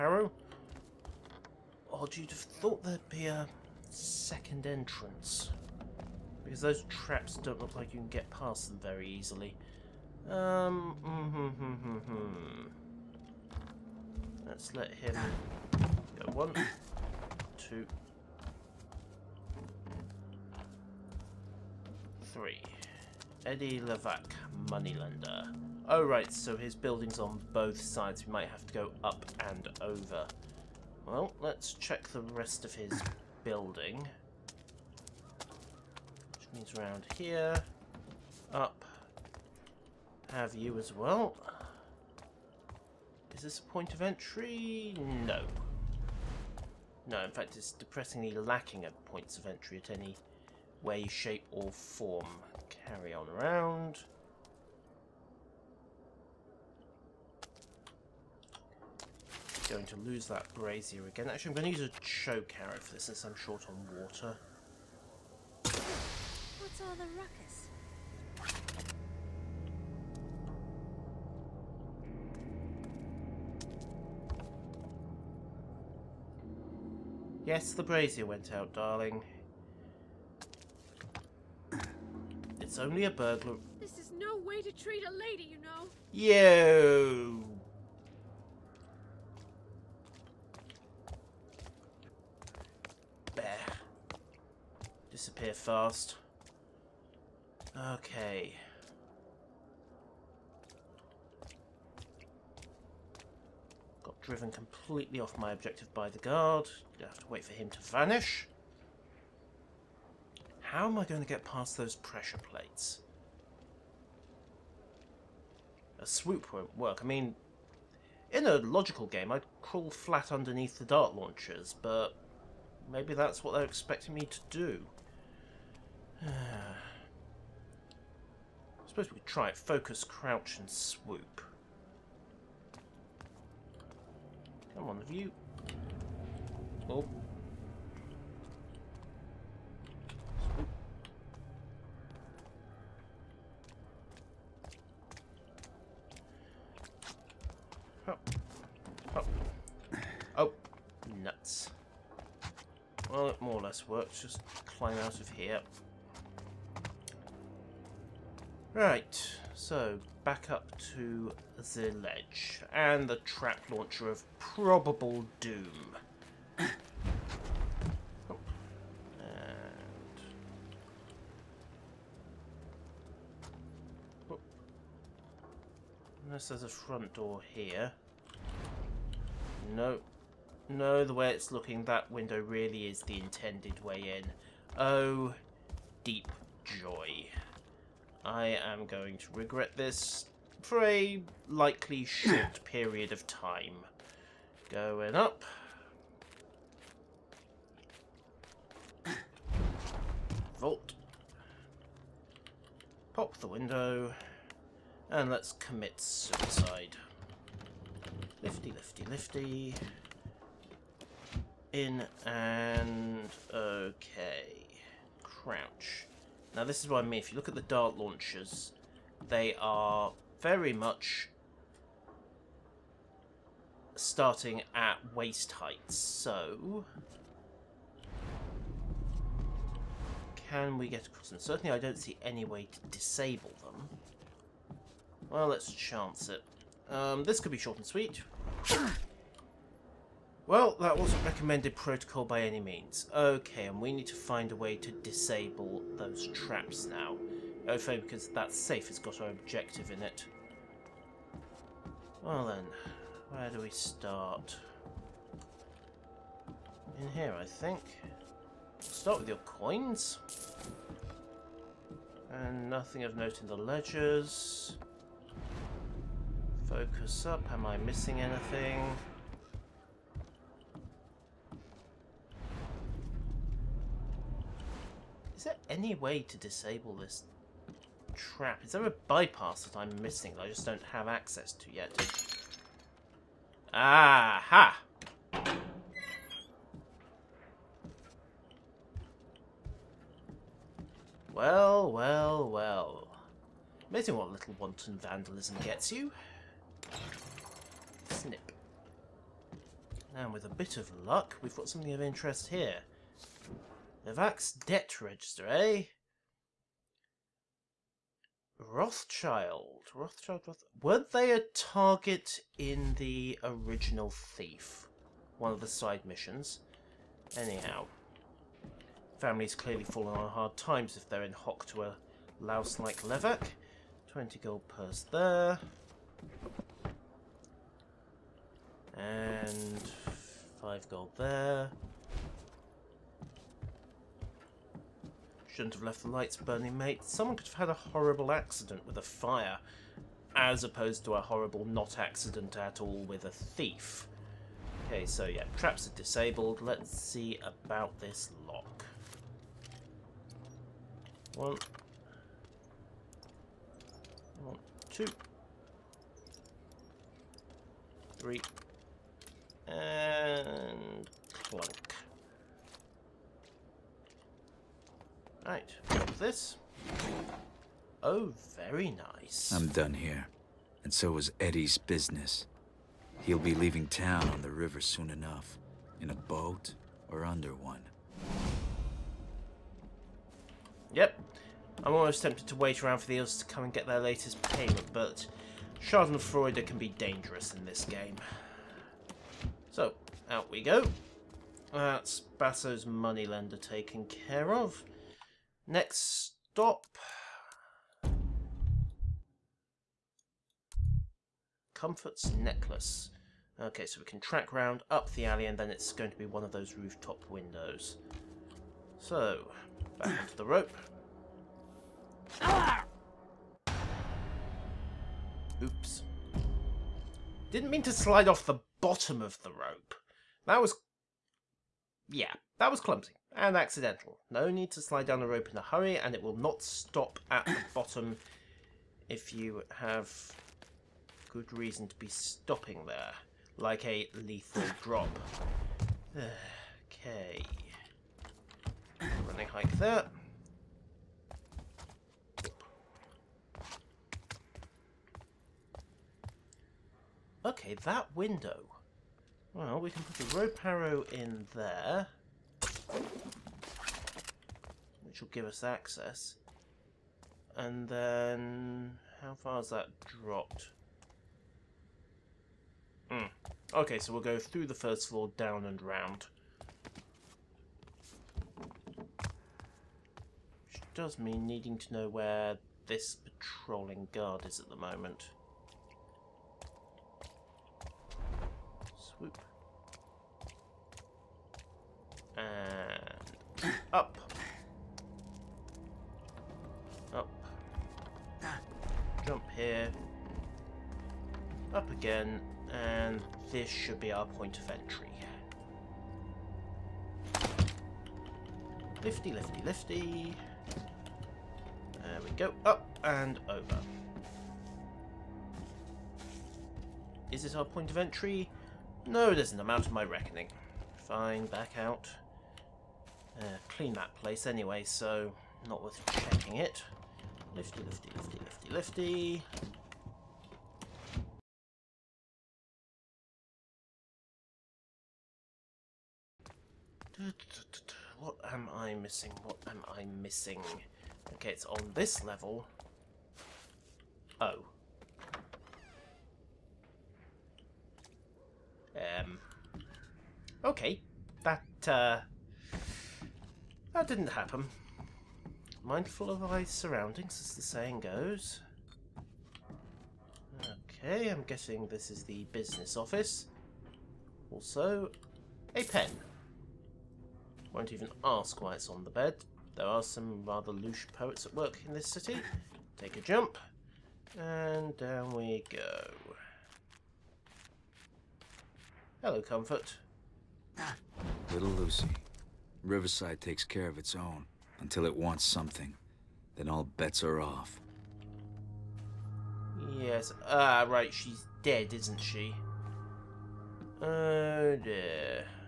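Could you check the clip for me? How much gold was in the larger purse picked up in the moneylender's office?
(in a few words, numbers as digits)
20 gold.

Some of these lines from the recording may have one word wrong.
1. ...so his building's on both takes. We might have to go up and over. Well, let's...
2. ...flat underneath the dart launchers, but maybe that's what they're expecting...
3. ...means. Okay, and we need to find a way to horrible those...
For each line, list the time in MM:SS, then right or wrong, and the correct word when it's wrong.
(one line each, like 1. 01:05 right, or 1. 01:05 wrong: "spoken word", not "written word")
1. 00:26 wrong: "sides", not "takes"
2. 01:59 right
3. 04:02 wrong: "disable", not "horrible".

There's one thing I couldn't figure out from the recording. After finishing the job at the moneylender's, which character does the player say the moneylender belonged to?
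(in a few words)
Basso.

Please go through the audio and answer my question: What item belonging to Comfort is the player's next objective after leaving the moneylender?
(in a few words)
necklace.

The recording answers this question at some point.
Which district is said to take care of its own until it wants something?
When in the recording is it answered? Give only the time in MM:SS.
09:32.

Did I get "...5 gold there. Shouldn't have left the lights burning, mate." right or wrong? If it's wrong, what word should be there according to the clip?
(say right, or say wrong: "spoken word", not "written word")
right.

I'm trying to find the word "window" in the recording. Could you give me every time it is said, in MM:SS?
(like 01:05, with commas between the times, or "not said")
03:02, 03:23, 06:47, 07:28.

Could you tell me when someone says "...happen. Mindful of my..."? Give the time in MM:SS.
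09:04.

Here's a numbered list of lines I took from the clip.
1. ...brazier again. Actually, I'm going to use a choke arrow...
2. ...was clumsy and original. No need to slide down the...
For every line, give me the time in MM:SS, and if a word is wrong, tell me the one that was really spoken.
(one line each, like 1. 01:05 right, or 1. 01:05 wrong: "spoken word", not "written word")
1. 01:00 right
2. 07:02 wrong: "accidental", not "original".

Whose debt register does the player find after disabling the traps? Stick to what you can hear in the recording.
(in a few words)
Novak.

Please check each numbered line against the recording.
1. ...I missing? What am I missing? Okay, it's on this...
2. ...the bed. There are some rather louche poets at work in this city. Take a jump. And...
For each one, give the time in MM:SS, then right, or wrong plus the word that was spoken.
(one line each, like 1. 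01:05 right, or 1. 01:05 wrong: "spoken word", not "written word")
1. 08:48 right
2. 09:19 right.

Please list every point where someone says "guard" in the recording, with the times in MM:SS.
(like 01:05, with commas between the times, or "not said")
01:46, 07:54.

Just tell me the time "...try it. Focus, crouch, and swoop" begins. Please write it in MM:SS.
02:09.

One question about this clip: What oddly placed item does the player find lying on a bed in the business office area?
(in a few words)
a pen.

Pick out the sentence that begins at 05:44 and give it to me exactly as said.
Okay, so yeah, traps are disabled.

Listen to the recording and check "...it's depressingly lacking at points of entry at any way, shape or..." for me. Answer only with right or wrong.
right.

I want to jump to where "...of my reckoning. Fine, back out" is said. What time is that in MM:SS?
08:29.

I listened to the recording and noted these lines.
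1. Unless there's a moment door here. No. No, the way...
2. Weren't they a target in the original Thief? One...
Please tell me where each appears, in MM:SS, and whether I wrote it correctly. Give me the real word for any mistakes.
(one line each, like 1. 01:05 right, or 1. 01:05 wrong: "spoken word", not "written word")
1. 02:56 wrong: "front", not "moment"
2. 05:10 right.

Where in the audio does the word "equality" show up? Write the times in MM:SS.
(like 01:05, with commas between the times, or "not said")
not said.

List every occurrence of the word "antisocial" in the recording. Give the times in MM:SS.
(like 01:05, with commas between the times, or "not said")
not said.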